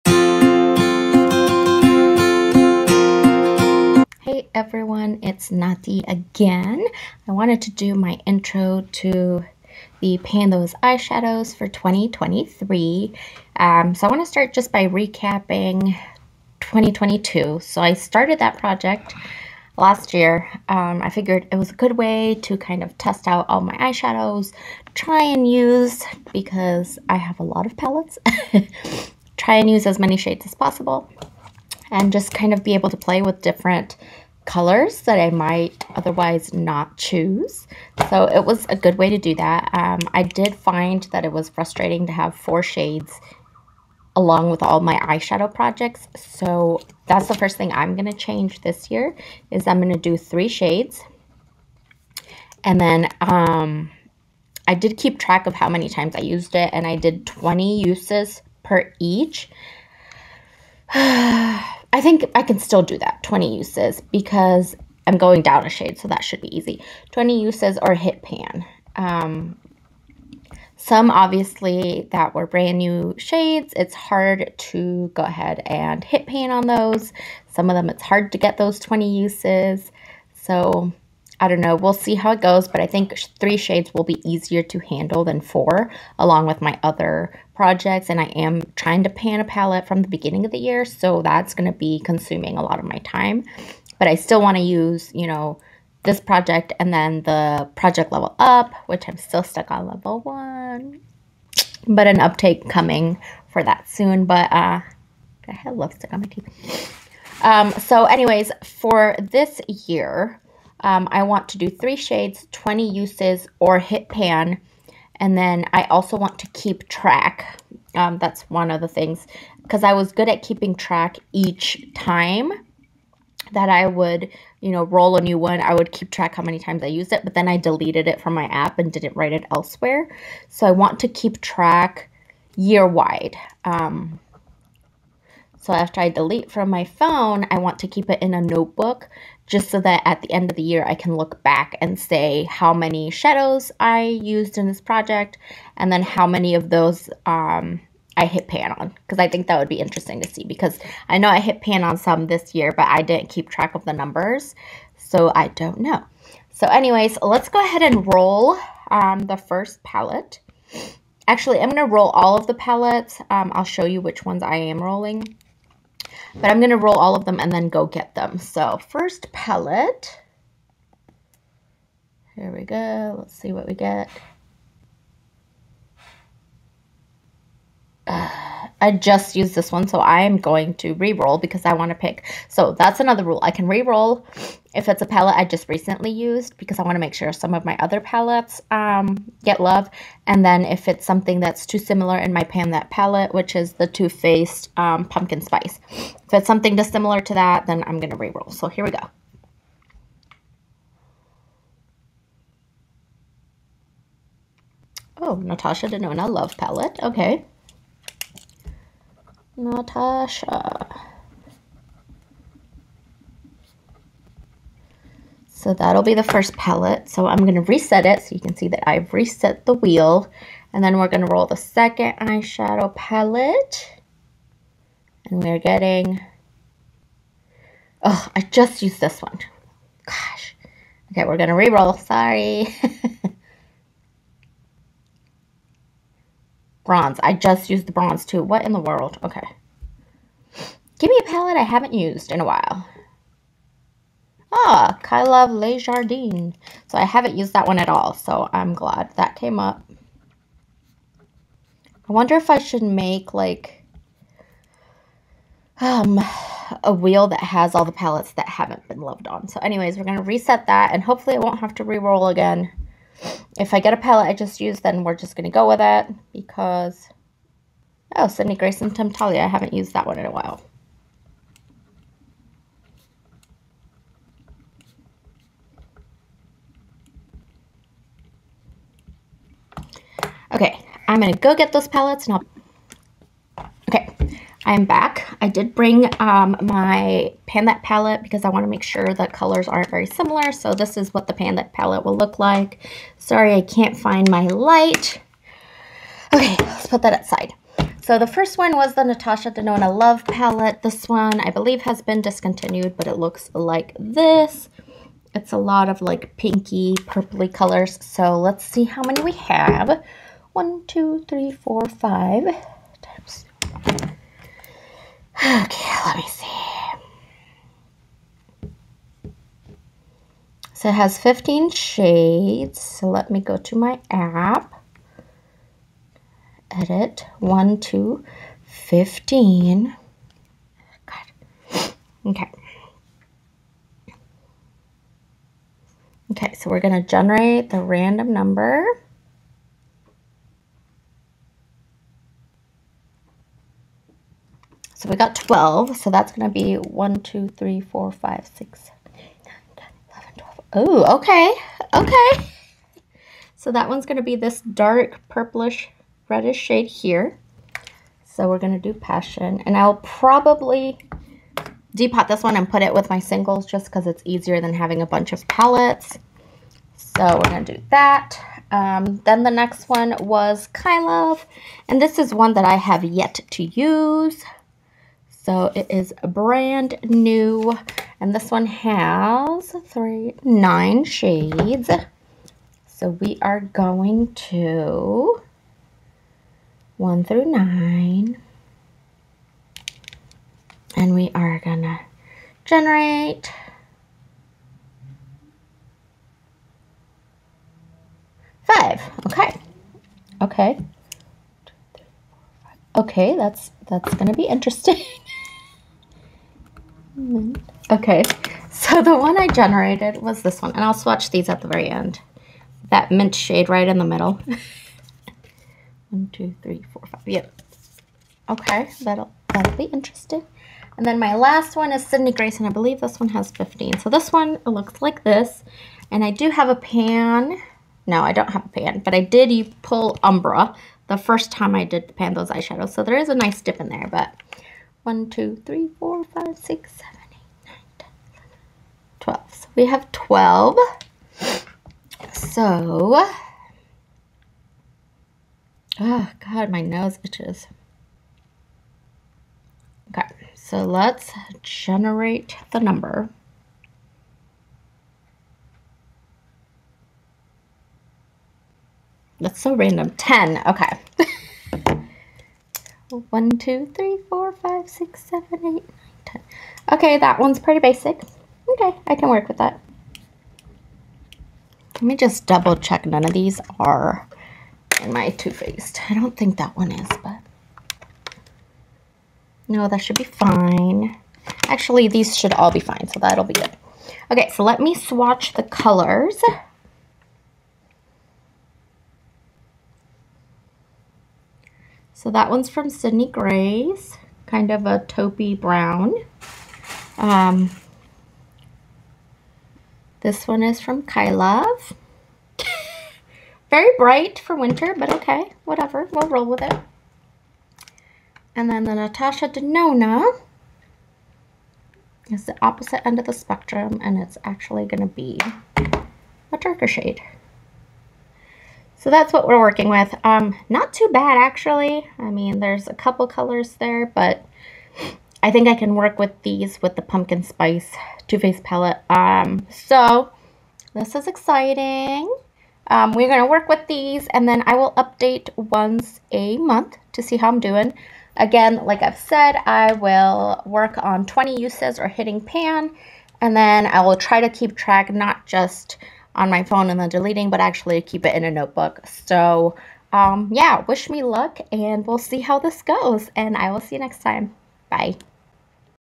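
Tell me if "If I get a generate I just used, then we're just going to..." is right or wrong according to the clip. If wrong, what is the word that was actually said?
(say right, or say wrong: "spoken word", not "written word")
wrong: "palette", not "generate".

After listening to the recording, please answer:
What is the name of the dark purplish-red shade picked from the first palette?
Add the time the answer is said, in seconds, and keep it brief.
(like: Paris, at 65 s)
Passion, at 358 s.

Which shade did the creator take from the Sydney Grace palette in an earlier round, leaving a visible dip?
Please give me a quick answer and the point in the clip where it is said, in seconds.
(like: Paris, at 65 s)
Umbra, at 430 s.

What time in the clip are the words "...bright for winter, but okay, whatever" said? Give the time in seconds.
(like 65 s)
503 s.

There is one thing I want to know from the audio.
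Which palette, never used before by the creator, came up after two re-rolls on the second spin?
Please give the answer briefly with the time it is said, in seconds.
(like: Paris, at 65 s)
Le Jardin, at 245 s.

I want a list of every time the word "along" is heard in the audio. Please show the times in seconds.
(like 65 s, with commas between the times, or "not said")
44 s, 86 s.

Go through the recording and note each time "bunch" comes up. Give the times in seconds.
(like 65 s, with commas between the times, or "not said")
365 s.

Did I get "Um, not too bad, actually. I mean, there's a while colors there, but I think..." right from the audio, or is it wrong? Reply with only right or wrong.
wrong.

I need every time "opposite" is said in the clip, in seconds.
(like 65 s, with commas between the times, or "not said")
512 s.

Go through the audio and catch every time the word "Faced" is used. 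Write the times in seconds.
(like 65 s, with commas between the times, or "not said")
194 s, 475 s, 528 s.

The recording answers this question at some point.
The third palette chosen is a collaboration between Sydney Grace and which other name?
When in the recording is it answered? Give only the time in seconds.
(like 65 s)
268 s.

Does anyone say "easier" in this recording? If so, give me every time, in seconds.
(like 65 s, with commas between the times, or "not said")
84 s, 364 s.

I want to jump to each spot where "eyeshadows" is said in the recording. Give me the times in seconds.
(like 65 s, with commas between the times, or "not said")
10 s, 23 s, 44 s, 222 s, 432 s.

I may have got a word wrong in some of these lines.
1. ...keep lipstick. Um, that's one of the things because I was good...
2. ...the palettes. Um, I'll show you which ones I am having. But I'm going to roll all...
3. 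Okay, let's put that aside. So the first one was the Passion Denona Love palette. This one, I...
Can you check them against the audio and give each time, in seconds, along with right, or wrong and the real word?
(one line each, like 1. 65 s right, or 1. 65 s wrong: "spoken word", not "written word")
1. 116 s wrong: "track", not "lipstick"
2. 162 s wrong: "rolling", not "having"
3. 296 s wrong: "Natasha", not "Passion".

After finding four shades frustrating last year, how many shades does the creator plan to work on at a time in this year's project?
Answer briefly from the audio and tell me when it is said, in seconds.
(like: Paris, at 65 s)
3, at 49 s.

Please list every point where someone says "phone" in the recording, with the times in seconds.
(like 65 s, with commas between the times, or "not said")
136 s, 546 s.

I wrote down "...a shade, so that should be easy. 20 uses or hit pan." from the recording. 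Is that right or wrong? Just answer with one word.
right.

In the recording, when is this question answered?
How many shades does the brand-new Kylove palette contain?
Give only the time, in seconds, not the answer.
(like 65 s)
380 s.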